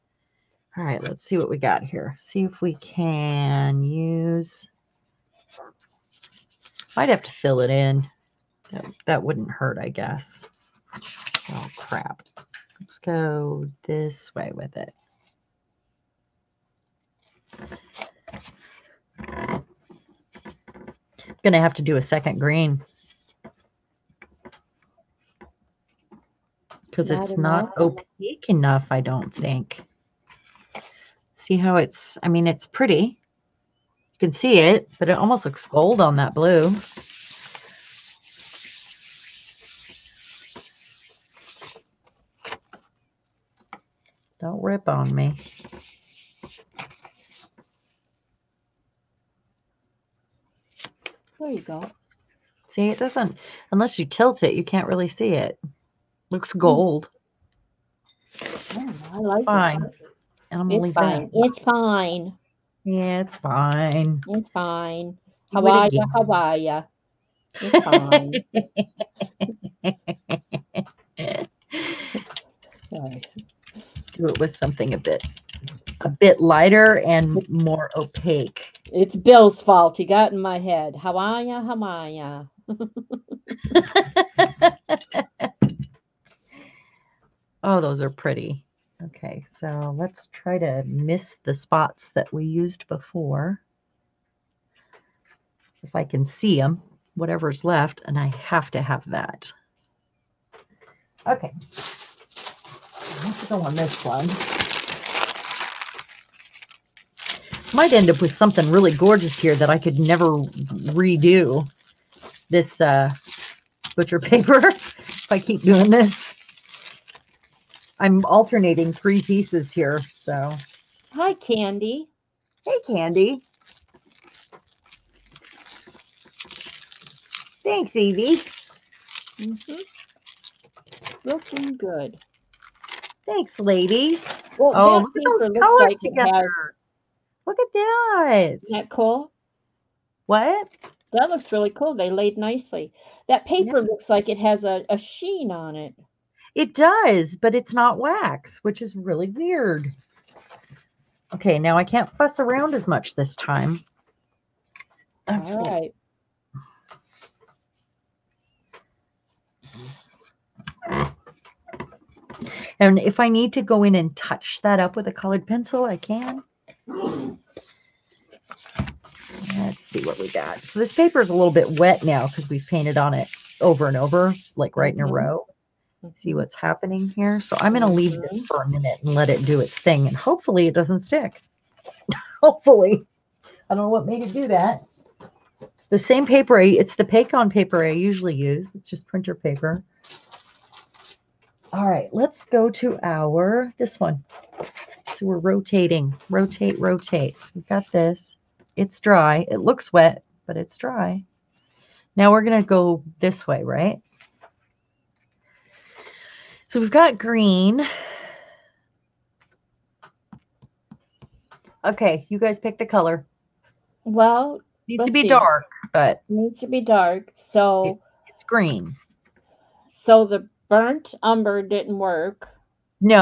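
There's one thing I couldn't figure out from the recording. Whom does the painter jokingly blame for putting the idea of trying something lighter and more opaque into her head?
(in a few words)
Bill.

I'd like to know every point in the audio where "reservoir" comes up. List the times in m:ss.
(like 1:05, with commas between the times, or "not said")
not said.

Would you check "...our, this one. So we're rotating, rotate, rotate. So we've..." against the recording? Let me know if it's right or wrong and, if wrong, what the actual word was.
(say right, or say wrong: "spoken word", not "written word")
right.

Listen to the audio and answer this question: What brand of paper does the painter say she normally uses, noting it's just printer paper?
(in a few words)
Pacon.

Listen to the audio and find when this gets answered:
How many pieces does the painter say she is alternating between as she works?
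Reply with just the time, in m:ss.
1:58.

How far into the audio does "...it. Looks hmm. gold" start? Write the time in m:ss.
0:55.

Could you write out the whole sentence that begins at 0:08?
That, that wouldn't hurt, I guess.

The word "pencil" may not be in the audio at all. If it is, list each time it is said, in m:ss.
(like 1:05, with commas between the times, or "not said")
2:45.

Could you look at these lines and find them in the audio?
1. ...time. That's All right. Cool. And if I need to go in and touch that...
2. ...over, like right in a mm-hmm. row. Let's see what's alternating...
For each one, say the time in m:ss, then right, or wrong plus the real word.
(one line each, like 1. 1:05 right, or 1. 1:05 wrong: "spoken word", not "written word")
1. 2:33 right
2. 2:53 wrong: "happening", not "alternating".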